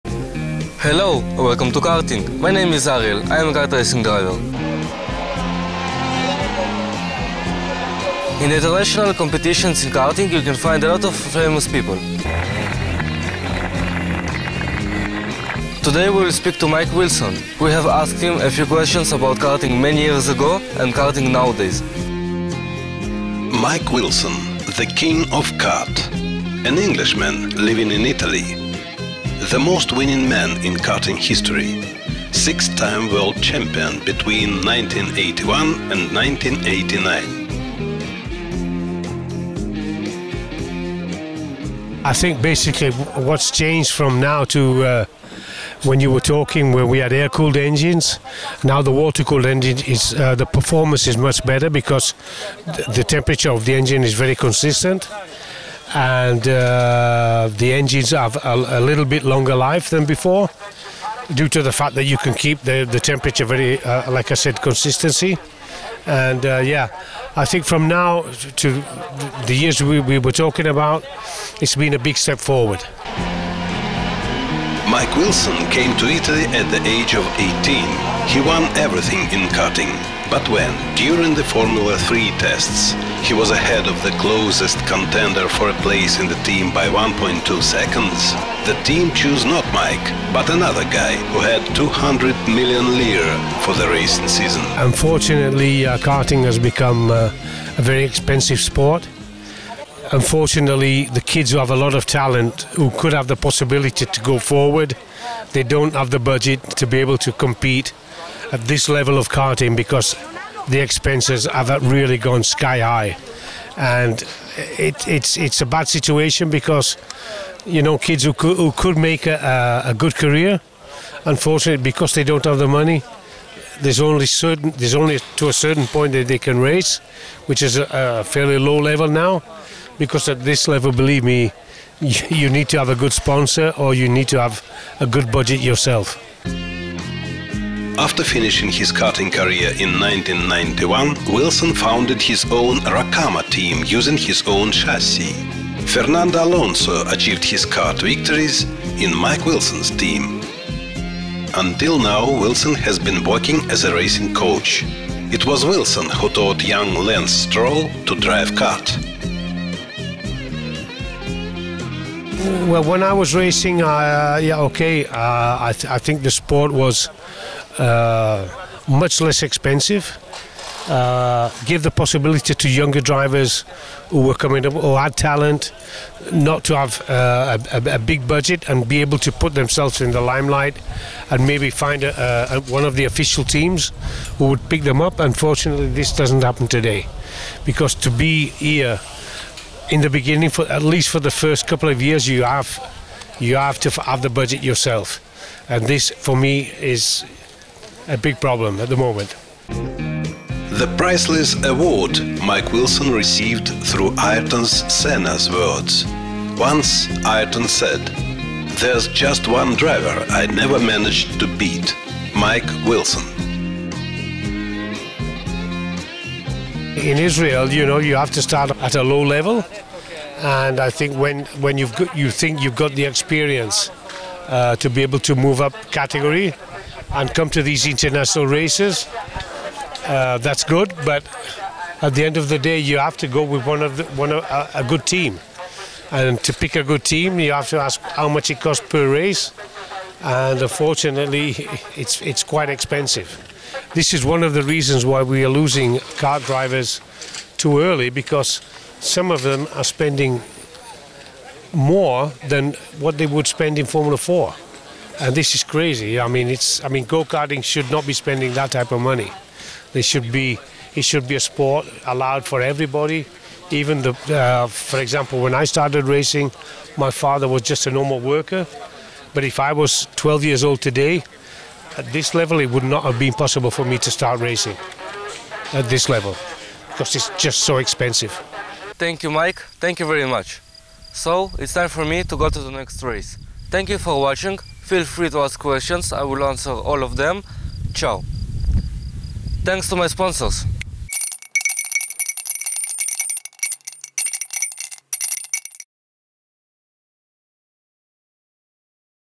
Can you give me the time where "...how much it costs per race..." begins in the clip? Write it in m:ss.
3:58.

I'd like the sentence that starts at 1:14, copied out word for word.
Mike Wilson came to Italy at the age of 18.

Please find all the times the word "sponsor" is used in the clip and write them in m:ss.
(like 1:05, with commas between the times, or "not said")
2:13, 4:50.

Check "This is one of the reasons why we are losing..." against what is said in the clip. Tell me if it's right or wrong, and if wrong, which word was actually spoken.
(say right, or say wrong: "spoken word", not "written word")
right.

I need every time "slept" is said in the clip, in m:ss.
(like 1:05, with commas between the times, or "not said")
not said.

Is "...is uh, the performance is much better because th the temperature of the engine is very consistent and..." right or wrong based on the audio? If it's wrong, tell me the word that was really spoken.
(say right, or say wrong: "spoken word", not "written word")
right.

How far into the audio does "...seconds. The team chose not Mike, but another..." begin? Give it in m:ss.
1:27.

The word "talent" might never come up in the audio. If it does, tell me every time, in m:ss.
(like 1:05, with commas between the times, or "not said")
1:42, 2:55.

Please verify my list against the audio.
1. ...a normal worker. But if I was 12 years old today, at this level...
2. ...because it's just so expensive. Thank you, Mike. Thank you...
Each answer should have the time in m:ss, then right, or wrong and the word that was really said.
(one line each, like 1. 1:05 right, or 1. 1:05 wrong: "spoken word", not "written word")
1. 4:27 right
2. 4:36 right.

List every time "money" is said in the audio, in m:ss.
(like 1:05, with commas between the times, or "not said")
2:02, 4:18.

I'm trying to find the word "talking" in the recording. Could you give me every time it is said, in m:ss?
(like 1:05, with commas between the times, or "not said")
0:46, 1:10.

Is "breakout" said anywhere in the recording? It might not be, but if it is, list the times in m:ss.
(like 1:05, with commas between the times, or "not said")
not said.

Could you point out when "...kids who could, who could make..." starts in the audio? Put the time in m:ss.
1:57.